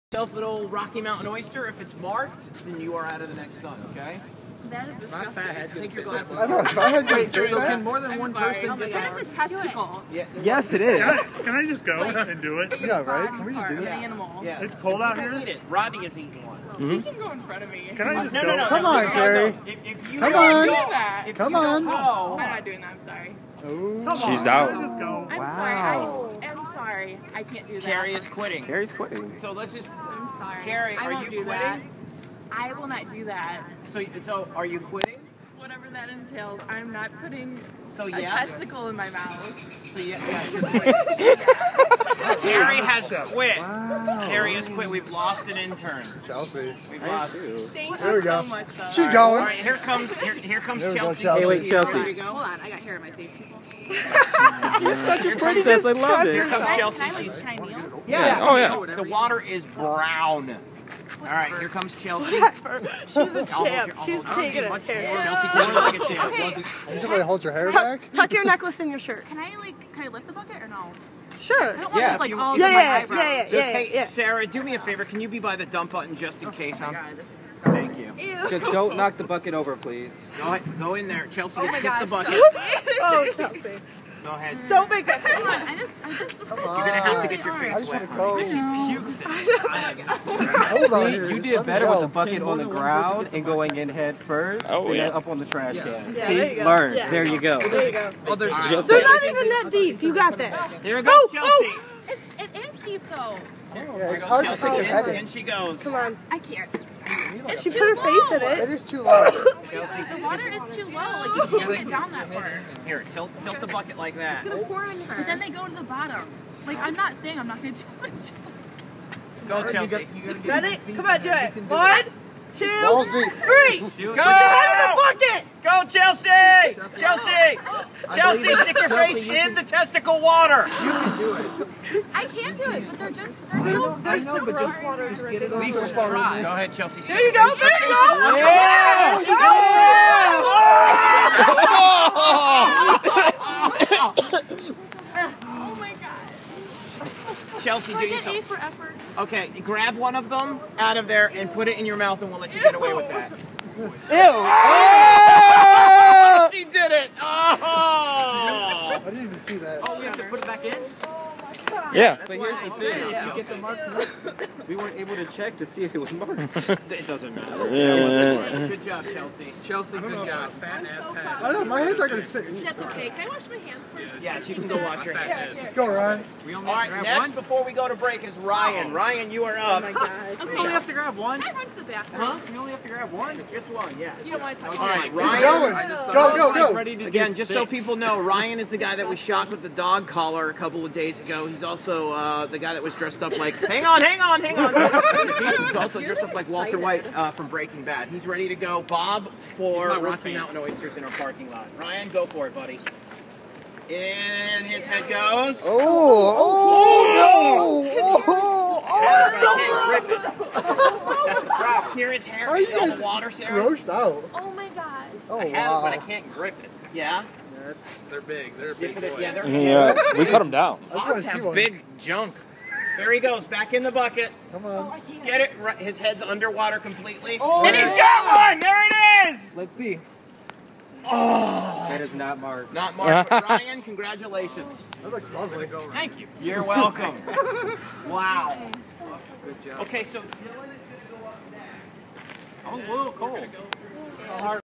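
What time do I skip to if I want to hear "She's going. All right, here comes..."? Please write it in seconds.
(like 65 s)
48 s.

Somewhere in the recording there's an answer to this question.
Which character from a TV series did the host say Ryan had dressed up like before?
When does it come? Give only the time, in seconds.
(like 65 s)
196 s.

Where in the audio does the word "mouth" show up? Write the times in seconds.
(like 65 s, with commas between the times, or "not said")
39 s, 151 s.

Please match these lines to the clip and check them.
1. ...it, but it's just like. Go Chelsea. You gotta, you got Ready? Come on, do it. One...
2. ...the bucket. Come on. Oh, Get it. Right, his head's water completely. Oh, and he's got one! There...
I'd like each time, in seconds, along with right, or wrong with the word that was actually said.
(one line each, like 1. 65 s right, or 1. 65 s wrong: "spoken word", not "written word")
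1. 117 s right
2. 223 s wrong: "underwater", not "water".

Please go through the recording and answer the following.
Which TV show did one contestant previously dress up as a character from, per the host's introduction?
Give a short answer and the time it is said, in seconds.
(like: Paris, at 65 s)
Breaking Bad, at 197 s.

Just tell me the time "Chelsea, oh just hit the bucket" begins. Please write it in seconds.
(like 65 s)
81 s.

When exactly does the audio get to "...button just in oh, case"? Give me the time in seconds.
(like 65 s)
75 s.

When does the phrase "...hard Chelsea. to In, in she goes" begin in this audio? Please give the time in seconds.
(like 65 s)
104 s.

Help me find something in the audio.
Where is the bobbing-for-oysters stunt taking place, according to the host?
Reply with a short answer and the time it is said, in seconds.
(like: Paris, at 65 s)
Parking lot, at 201 s.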